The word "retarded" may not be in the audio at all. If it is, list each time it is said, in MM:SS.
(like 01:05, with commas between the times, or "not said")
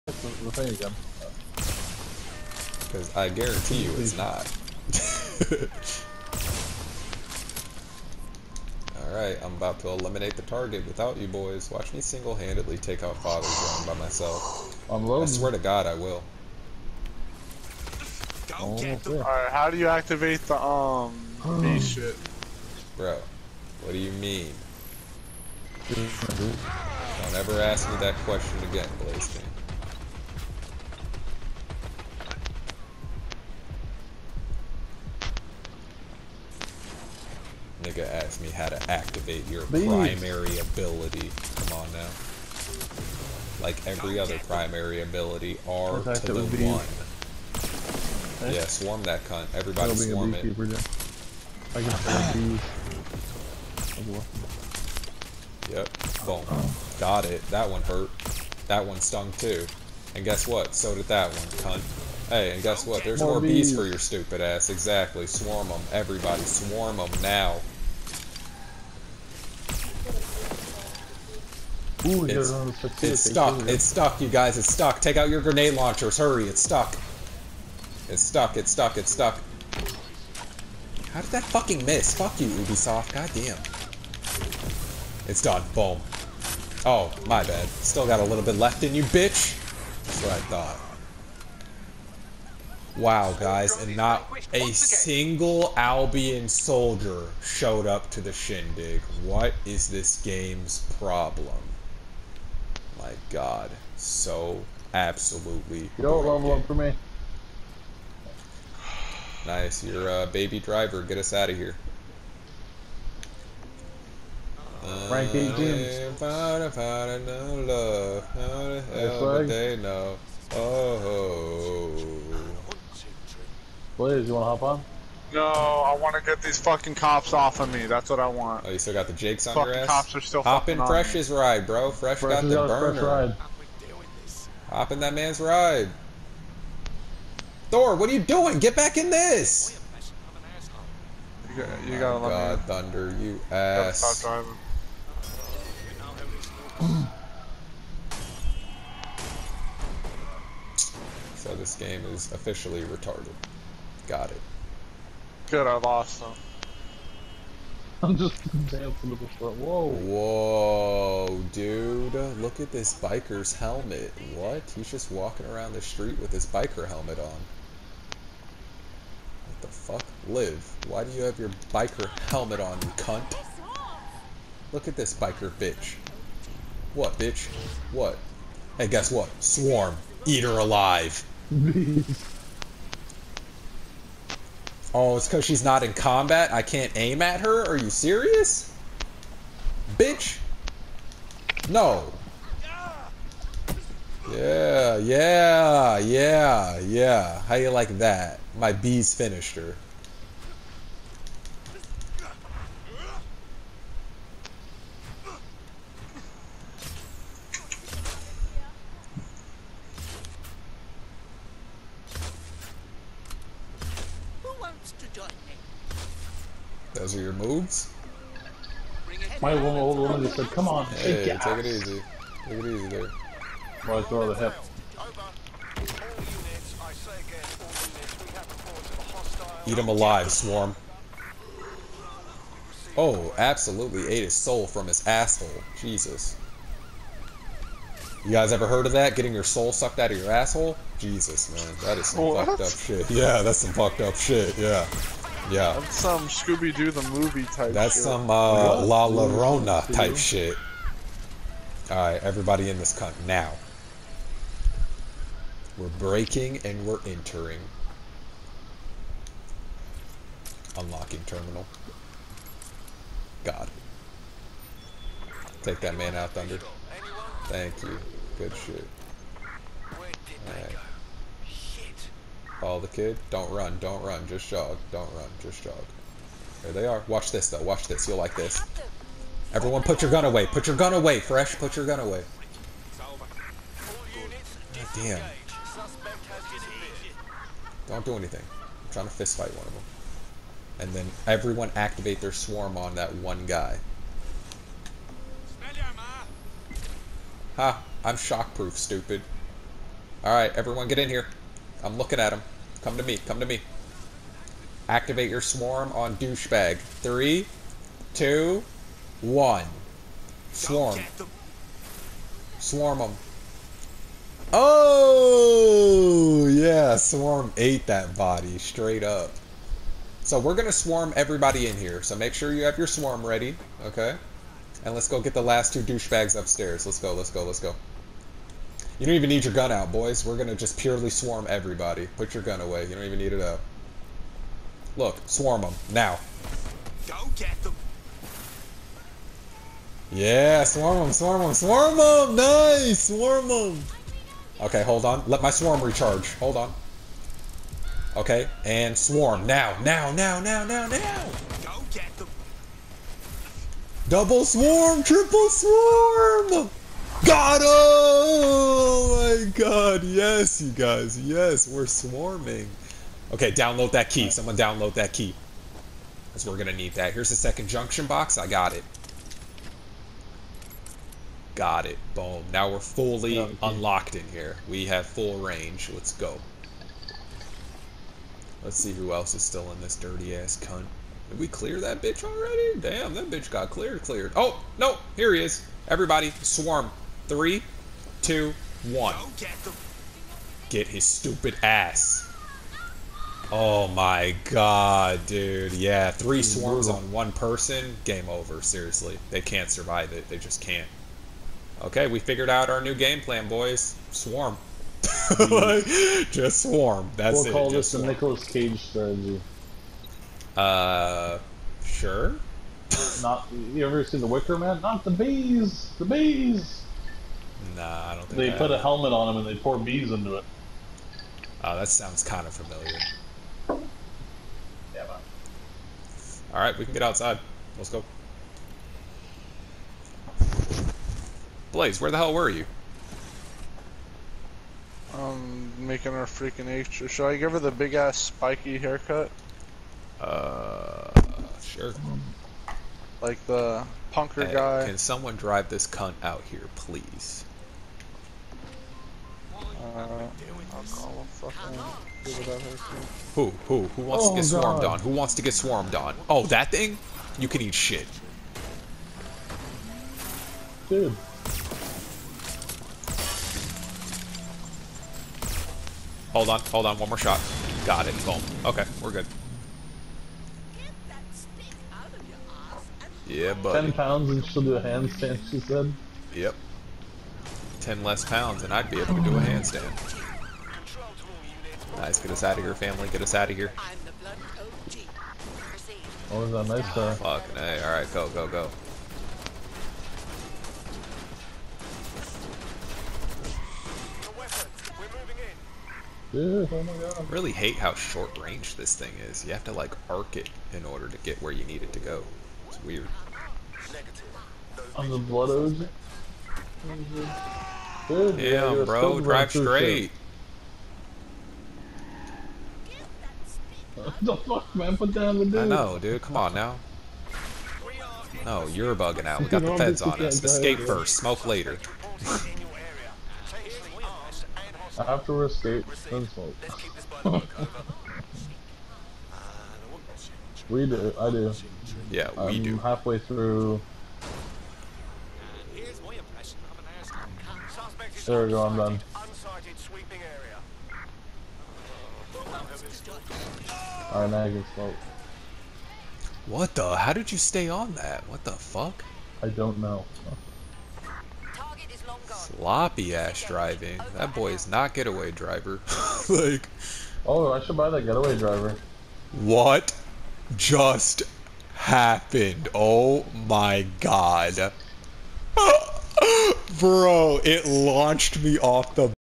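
02:32.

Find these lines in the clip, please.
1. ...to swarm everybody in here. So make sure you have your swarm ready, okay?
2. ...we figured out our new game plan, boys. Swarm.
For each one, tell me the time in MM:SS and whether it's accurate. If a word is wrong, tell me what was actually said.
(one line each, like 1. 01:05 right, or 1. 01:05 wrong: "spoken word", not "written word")
1. 05:20 right
2. 06:42 right.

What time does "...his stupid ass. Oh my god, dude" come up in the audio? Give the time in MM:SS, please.
06:30.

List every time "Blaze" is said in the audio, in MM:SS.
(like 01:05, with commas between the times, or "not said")
00:29, 02:03, 07:11.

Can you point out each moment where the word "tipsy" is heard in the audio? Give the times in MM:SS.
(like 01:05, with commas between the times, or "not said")
not said.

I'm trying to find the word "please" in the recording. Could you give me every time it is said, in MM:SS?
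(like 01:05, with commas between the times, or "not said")
00:39, 07:26.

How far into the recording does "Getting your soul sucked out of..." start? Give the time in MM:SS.
03:59.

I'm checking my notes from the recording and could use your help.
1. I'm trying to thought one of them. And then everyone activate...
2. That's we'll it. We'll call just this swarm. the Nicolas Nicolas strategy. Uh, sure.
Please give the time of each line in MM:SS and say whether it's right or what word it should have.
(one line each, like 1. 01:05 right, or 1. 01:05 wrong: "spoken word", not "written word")
1. 04:48 wrong: "fistfight", not "thought"
2. 06:47 wrong: "Cage", not "Nicolas".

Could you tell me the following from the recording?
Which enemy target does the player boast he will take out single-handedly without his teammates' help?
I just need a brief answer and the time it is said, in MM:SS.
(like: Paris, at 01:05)
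Father Drone, at 00:13.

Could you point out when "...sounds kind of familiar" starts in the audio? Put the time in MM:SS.
07:01.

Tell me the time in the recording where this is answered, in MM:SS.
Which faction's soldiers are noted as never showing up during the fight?
01:35.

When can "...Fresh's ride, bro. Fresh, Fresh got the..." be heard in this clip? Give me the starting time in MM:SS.
02:10.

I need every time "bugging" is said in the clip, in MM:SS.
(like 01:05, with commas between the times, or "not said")
08:38.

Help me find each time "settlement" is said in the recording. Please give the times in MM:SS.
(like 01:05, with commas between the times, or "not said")
not said.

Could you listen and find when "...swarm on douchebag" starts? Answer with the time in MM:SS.
05:05.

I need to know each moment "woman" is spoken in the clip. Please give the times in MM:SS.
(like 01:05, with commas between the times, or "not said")
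03:39.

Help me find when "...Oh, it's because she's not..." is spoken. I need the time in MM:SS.
03:04.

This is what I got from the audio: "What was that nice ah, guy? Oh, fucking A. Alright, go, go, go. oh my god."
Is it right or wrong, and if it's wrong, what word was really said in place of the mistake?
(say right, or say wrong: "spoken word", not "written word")
right.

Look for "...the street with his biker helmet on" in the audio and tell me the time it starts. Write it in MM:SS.
02:45.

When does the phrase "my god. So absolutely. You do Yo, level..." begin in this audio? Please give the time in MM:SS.
01:43.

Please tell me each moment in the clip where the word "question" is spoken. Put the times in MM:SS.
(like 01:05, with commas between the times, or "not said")
00:28.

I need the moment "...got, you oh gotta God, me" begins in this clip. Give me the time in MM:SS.
02:21.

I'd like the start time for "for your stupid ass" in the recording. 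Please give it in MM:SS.
01:03.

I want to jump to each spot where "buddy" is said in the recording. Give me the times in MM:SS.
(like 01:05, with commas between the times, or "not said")
07:53.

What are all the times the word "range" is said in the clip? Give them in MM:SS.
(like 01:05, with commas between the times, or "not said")
06:15, 08:18.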